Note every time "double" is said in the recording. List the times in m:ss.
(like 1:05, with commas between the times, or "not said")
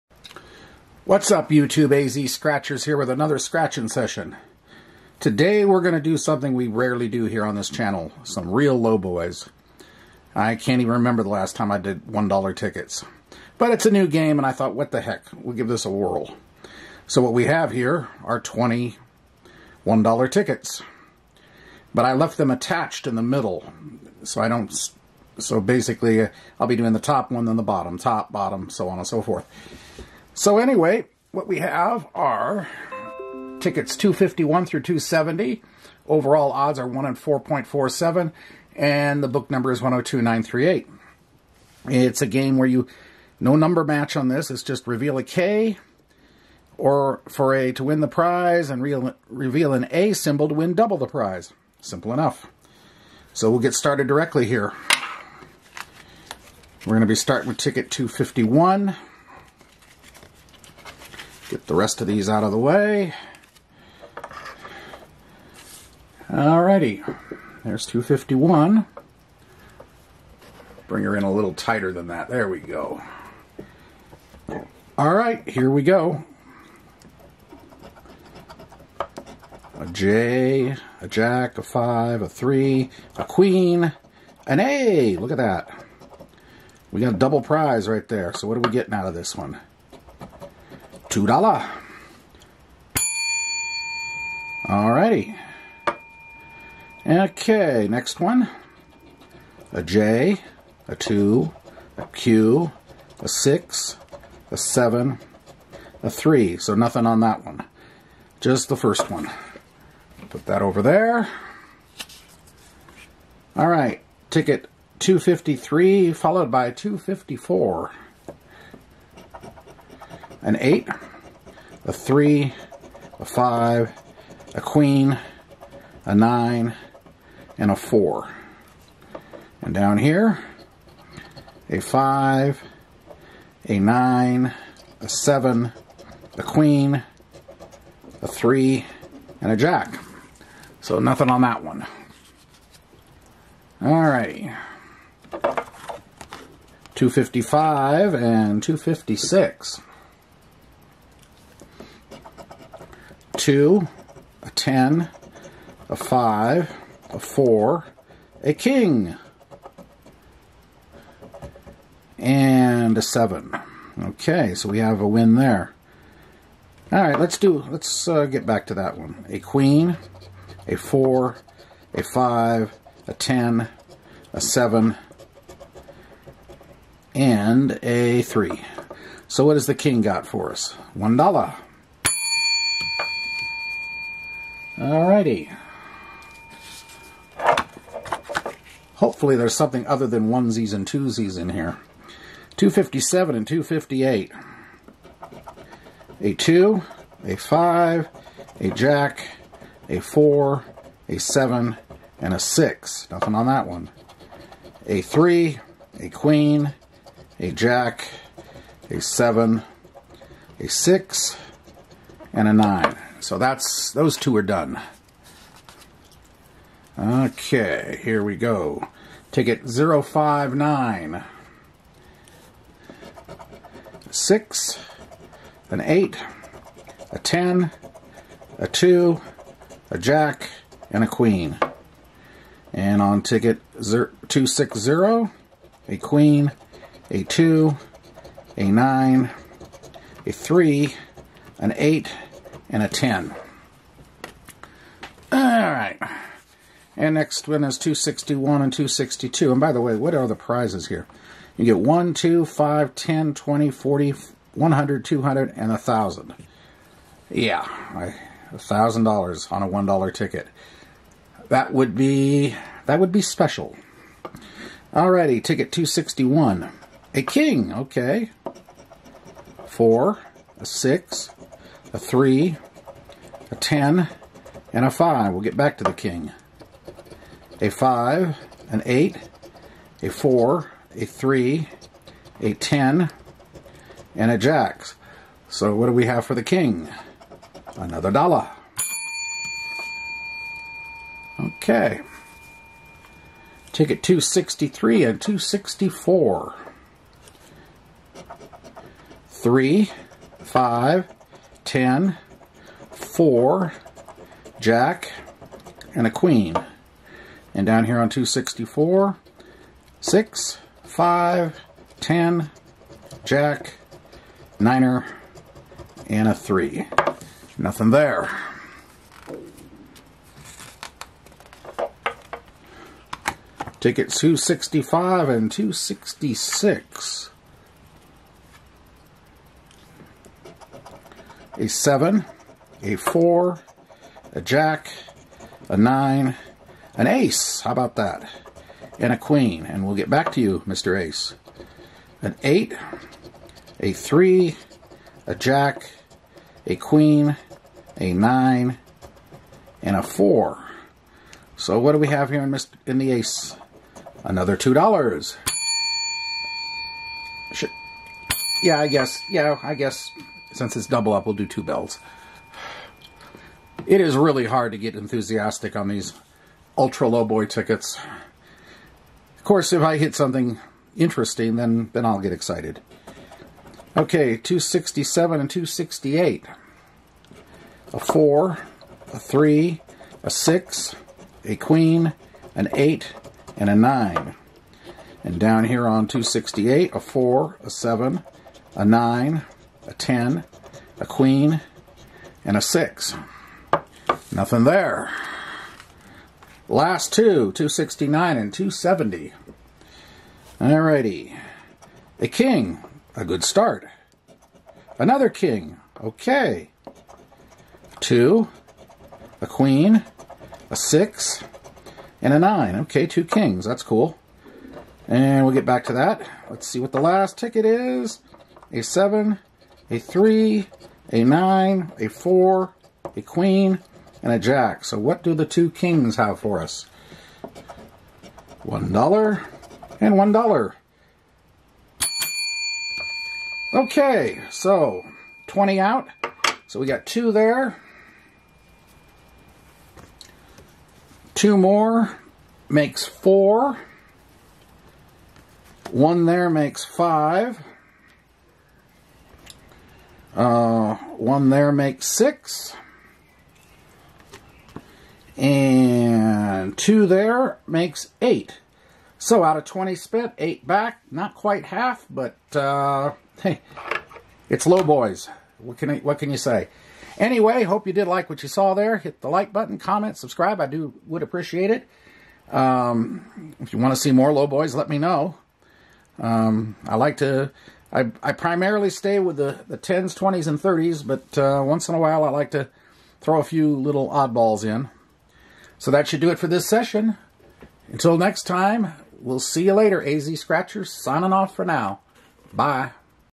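0:50, 1:27, 6:00.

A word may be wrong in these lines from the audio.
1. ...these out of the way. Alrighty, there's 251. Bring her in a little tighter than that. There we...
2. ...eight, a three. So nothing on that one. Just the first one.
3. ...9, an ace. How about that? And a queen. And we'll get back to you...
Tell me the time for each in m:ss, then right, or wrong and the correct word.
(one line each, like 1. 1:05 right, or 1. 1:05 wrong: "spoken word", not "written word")
1. 1:02 right
2. 1:44 wrong: "seven", not "eight"
3. 5:35 right.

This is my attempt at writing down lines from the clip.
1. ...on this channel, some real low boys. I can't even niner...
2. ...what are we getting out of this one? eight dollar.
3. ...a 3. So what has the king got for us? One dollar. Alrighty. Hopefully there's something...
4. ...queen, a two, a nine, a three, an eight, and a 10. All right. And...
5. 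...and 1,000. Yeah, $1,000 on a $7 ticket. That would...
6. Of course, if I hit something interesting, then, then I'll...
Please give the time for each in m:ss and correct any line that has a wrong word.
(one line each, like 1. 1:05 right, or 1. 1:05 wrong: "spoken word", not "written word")
1. 0:07 wrong: "remember", not "niner"
2. 1:28 wrong: "two", not "eight"
3. 2:57 right
4. 3:55 right
5. 4:15 wrong: "1", not "7"
6. 6:09 right.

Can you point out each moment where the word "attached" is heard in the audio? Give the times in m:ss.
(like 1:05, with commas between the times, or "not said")
0:22.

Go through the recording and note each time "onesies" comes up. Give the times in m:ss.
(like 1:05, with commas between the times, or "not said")
3:10.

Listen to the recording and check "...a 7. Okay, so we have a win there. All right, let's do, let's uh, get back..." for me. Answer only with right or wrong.
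right.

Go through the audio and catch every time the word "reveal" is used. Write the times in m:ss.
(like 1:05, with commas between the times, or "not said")
0:44, 0:49.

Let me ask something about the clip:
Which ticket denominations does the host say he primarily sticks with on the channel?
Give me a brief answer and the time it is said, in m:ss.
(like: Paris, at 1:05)
10s, 20s, and 30s, at 7:59.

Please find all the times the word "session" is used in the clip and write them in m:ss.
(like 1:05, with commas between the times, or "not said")
0:03, 8:06.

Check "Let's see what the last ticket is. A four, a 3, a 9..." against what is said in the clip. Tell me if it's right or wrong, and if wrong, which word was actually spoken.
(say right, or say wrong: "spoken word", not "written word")
wrong: "seven", not "four".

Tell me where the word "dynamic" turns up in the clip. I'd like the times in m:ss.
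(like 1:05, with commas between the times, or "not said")
not said.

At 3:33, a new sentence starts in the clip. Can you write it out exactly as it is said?
So that's those two are done.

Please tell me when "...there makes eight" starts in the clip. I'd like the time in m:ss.
7:37.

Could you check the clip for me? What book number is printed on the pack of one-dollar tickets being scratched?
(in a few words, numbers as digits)
102938.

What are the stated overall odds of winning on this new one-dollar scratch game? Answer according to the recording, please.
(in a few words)
1 in 4.47.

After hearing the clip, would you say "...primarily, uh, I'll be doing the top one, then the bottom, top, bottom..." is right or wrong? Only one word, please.
wrong.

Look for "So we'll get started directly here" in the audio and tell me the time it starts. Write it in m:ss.
0:53.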